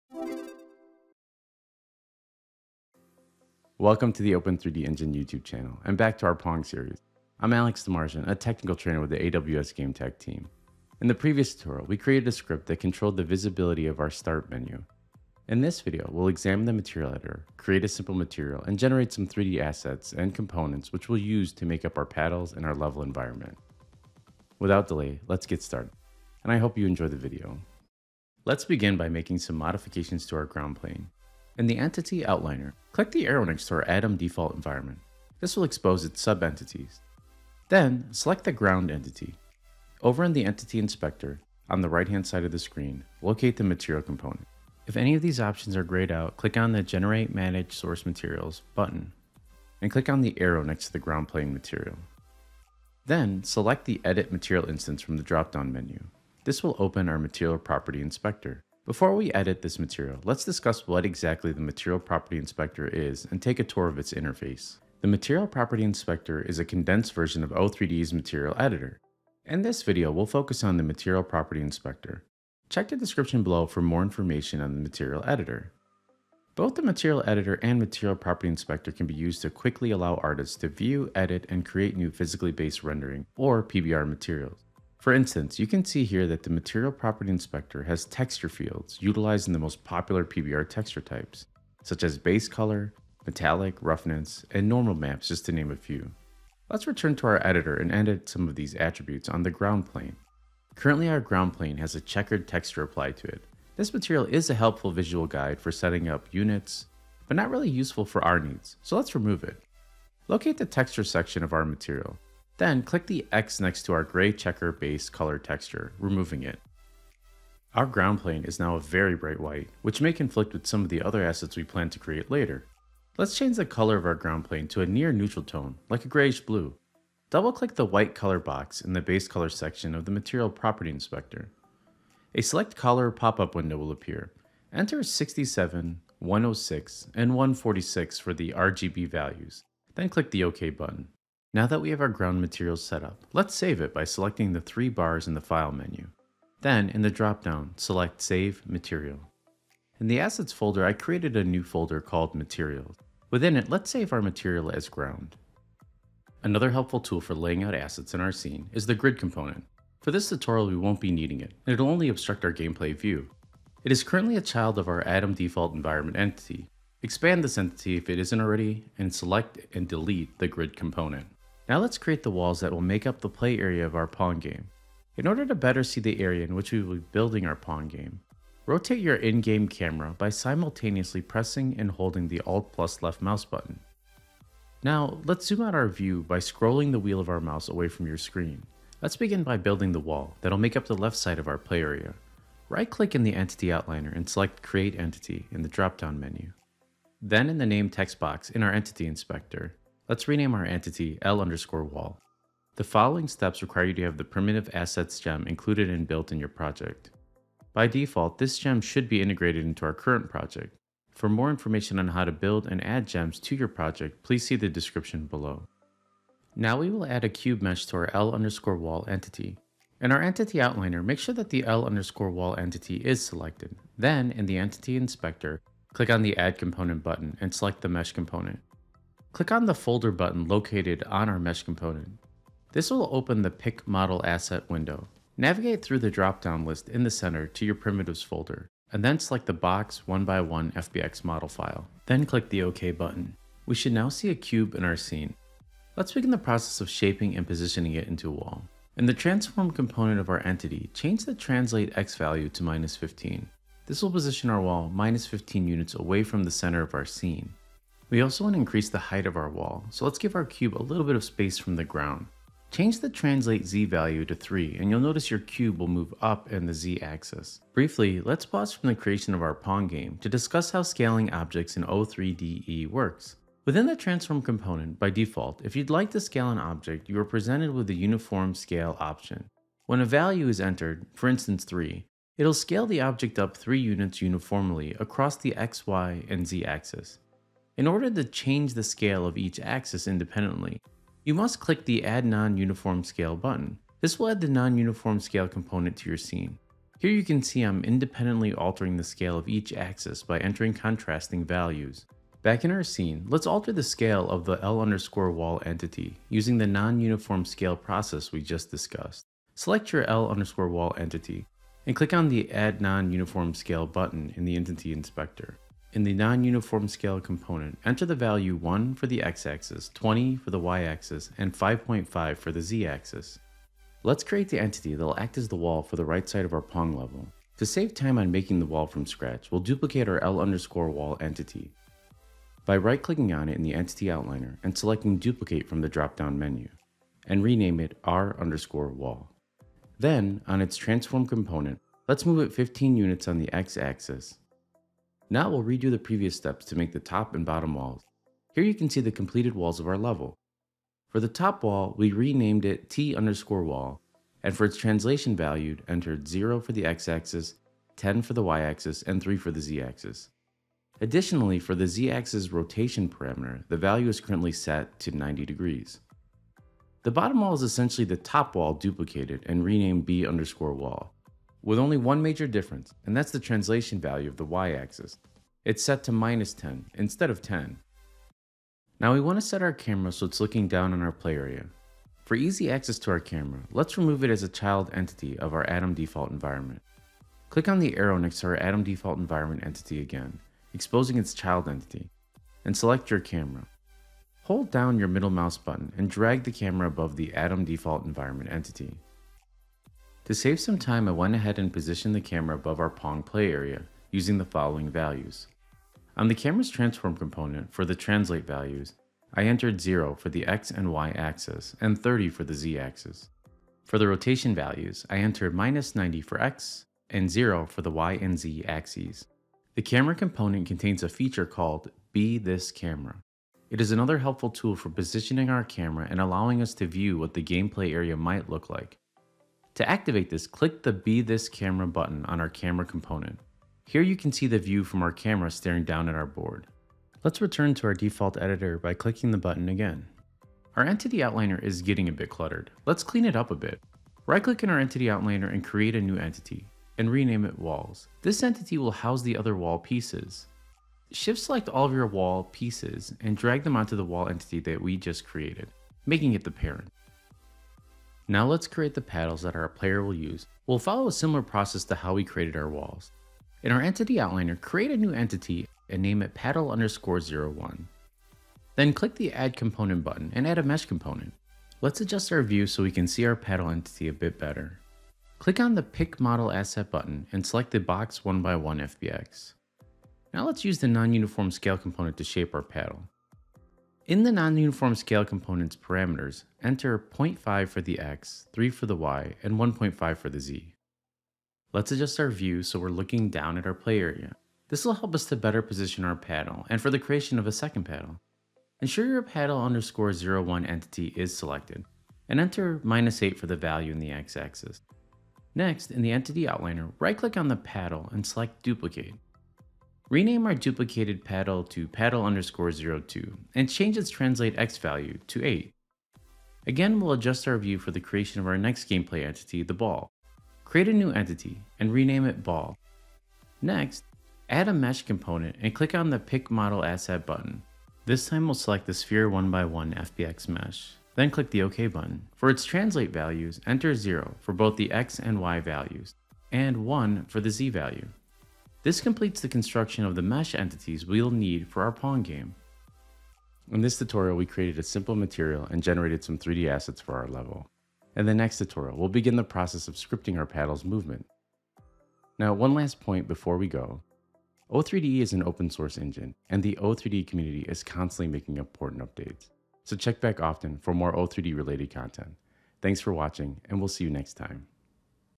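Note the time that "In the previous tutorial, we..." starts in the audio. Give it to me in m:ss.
0:11.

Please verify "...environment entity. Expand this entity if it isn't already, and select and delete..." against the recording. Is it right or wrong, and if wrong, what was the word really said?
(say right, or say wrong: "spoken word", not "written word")
right.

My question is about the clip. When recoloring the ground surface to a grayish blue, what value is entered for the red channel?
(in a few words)
67.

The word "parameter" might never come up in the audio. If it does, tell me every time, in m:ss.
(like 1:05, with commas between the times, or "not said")
6:03, 8:05.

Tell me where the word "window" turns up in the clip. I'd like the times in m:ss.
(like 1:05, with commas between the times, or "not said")
2:13, 3:54.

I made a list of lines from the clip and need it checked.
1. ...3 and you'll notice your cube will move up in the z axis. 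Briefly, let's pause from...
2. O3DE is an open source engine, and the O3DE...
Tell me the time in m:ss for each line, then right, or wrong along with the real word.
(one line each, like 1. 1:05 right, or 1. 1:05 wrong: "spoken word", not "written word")
1. 4:24 right
2. 9:14 right.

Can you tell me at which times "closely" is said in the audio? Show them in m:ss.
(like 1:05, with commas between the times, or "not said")
not said.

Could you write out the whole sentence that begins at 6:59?
The camera component contains a feature called Be This Camera.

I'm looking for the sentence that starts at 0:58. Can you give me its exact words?
Before we edit this material, let's discuss what exactly the Material Property Inspector is and take a tour of its interface.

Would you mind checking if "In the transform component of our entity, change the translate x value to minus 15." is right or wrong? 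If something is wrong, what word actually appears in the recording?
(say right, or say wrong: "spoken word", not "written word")
right.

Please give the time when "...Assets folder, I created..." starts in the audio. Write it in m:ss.
2:30.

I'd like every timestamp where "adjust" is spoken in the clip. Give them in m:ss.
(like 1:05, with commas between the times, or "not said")
7:52, 8:11, 8:37.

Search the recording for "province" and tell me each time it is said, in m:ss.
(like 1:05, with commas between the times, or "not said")
not said.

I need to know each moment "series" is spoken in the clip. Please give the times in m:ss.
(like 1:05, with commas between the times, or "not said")
0:06.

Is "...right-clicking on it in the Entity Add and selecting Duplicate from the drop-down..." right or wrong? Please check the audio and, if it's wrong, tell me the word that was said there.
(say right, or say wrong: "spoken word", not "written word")
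wrong: "Outliner", not "Add".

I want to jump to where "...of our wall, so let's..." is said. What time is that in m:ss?
4:19.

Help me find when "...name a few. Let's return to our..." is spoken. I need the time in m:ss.
1:35.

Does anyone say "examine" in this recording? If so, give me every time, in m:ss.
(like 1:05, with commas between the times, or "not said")
0:16.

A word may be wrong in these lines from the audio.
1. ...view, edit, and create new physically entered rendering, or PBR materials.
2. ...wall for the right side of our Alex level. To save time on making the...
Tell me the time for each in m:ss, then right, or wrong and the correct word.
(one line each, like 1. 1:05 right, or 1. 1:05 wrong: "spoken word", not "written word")
1. 1:20 wrong: "based", not "entered"
2. 5:25 wrong: "Pong", not "Alex".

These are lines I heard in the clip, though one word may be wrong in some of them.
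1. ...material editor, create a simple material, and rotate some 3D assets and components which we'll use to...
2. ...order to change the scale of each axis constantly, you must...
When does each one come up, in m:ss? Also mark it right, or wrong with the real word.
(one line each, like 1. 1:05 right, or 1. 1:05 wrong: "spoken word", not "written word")
1. 0:16 wrong: "generate", not "rotate"
2. 4:47 wrong: "independently", not "constantly".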